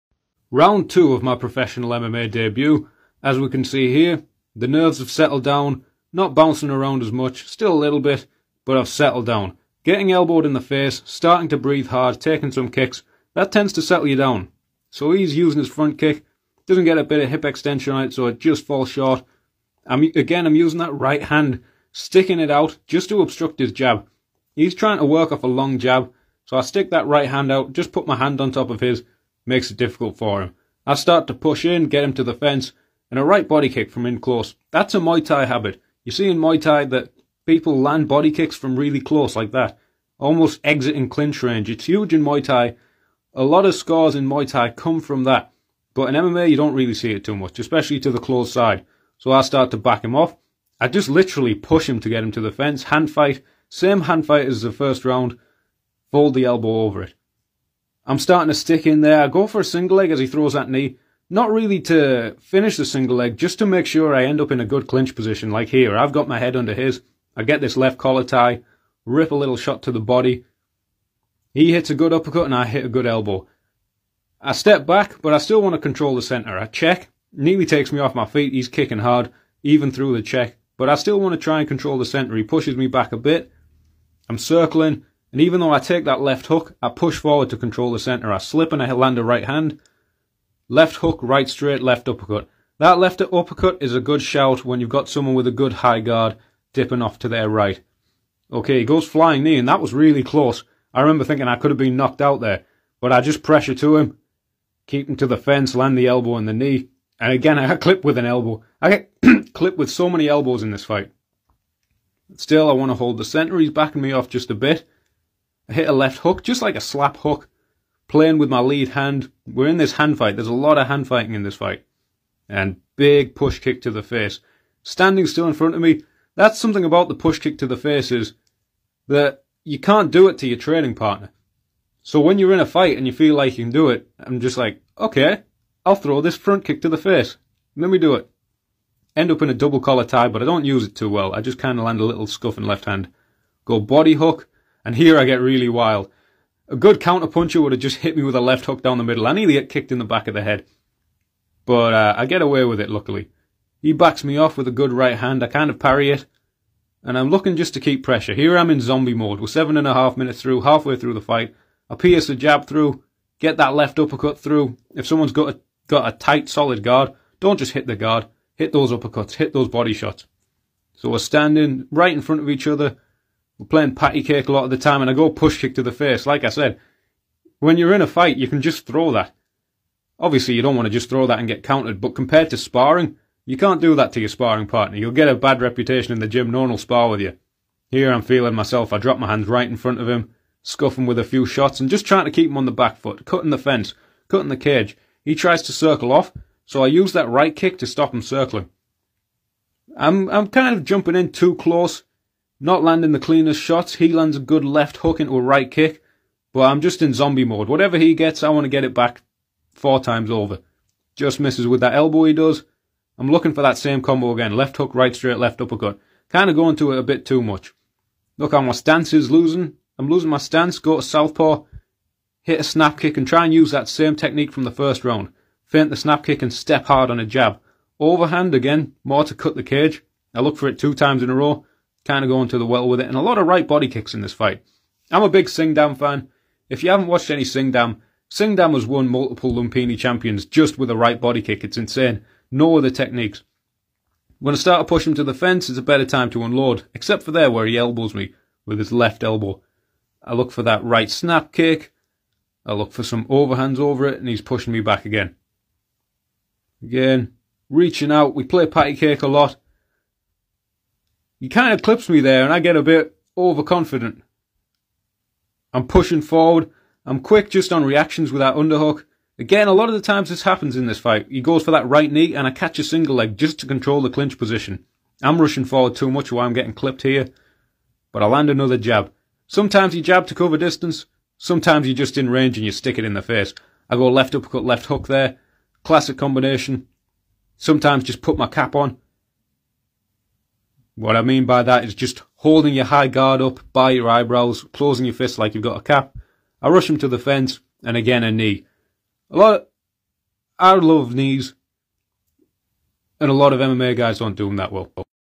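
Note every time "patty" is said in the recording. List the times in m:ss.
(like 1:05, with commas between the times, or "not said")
2:53, 4:18.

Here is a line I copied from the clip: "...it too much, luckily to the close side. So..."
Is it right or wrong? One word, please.
wrong.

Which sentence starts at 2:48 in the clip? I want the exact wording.
Hit those uppercuts, hit those body shots.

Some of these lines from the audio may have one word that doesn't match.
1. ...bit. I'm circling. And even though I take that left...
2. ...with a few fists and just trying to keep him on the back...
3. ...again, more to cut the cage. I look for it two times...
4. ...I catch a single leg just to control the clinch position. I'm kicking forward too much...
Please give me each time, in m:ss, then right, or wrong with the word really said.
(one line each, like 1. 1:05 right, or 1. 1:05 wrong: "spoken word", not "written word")
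1. 1:23 right
2. 3:11 wrong: "shots", not "fists"
3. 3:48 right
4. 4:32 wrong: "rushing", not "kicking".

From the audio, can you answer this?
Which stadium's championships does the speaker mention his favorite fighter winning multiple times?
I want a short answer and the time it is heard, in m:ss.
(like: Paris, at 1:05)
Lumpini, at 3:59.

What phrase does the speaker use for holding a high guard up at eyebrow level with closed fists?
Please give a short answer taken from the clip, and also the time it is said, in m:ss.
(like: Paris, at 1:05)
put my cap on, at 4:48.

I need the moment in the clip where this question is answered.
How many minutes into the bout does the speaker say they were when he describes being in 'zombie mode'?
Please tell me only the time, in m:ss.
2:39.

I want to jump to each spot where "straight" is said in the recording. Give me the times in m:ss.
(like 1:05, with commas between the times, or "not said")
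1:31, 3:35.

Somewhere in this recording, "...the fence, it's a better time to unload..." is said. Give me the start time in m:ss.
4:05.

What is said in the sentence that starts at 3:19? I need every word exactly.
I'm I'm kind of jumping in too close, not landing the cleanest shots.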